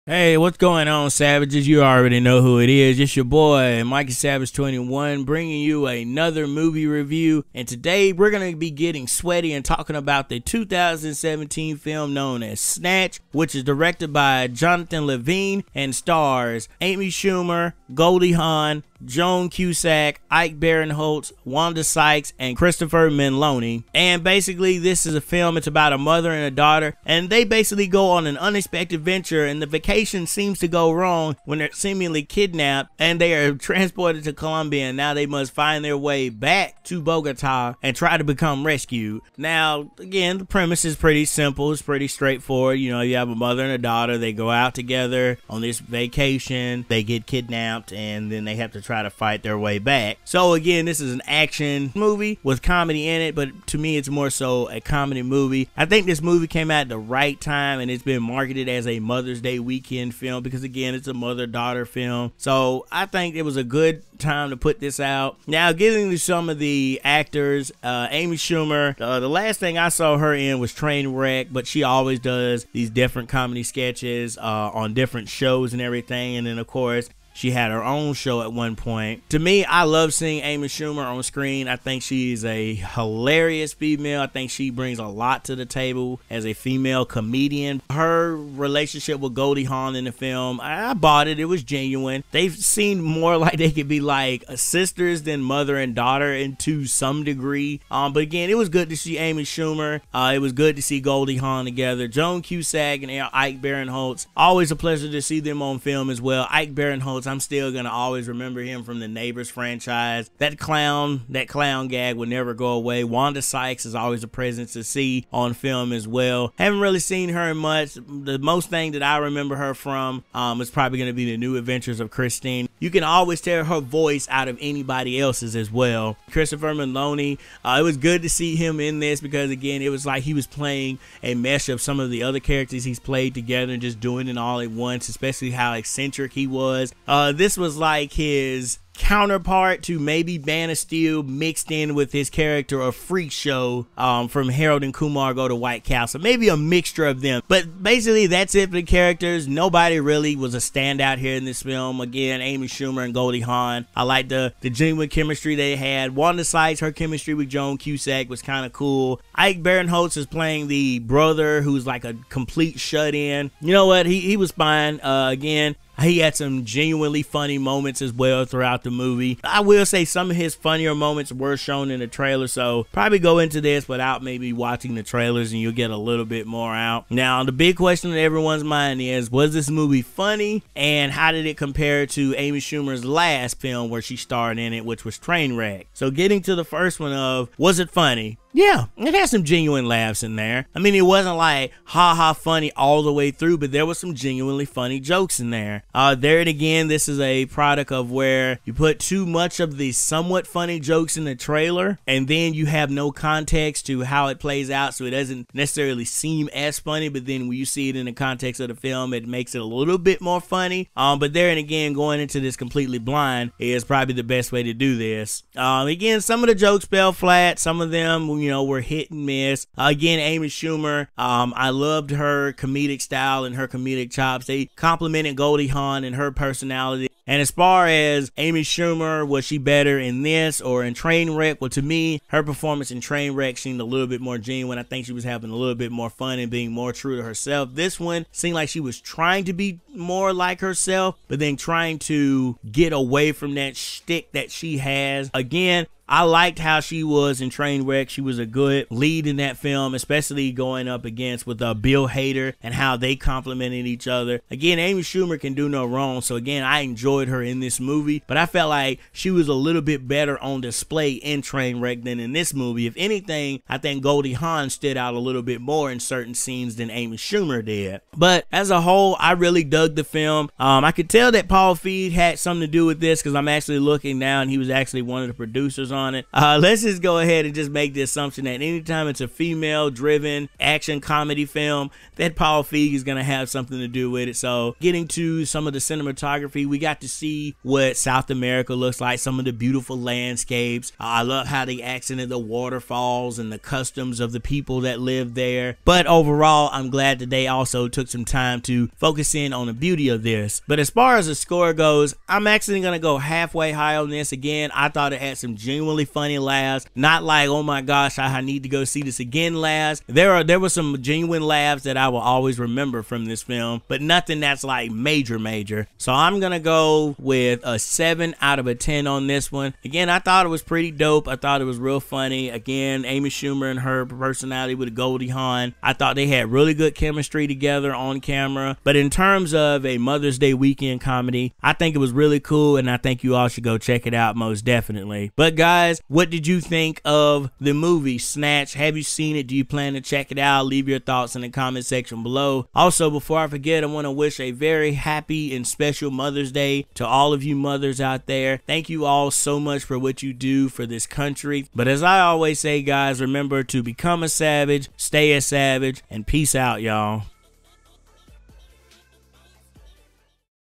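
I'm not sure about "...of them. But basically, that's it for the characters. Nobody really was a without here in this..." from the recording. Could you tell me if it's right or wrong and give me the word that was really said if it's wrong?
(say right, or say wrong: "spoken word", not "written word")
wrong: "standout", not "without".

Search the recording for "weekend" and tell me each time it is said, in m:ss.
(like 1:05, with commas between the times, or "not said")
0:59, 5:30.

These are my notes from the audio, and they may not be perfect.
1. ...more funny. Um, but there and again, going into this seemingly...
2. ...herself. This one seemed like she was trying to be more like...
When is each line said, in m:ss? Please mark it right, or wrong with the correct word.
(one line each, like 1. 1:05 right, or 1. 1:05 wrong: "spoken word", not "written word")
1. 3:30 wrong: "completely", not "seemingly"
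2. 3:57 right.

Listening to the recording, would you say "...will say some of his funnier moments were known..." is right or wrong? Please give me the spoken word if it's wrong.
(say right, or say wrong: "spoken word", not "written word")
wrong: "shown", not "known".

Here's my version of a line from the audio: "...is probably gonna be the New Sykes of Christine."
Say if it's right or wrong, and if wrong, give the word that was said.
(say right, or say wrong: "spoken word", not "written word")
wrong: "Adventures", not "Sykes".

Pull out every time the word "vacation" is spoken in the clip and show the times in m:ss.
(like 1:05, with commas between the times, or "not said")
0:29, 0:45.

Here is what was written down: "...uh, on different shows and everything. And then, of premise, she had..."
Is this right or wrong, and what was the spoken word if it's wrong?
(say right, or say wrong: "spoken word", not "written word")
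wrong: "course", not "premise".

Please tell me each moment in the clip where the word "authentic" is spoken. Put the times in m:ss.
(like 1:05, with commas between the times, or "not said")
not said.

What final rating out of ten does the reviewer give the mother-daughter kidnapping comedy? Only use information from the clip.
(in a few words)
7.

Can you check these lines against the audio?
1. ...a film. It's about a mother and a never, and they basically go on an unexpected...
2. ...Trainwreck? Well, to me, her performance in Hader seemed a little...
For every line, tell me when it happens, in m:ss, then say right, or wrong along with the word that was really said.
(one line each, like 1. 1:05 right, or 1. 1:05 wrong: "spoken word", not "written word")
1. 0:25 wrong: "daughter", not "never"
2. 3:50 wrong: "Trainwreck", not "Hader".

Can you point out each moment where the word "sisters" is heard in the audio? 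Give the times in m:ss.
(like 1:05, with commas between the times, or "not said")
1:34.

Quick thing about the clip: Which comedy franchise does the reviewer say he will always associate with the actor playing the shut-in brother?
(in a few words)
Neighbors.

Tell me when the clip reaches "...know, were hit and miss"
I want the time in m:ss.
3:38.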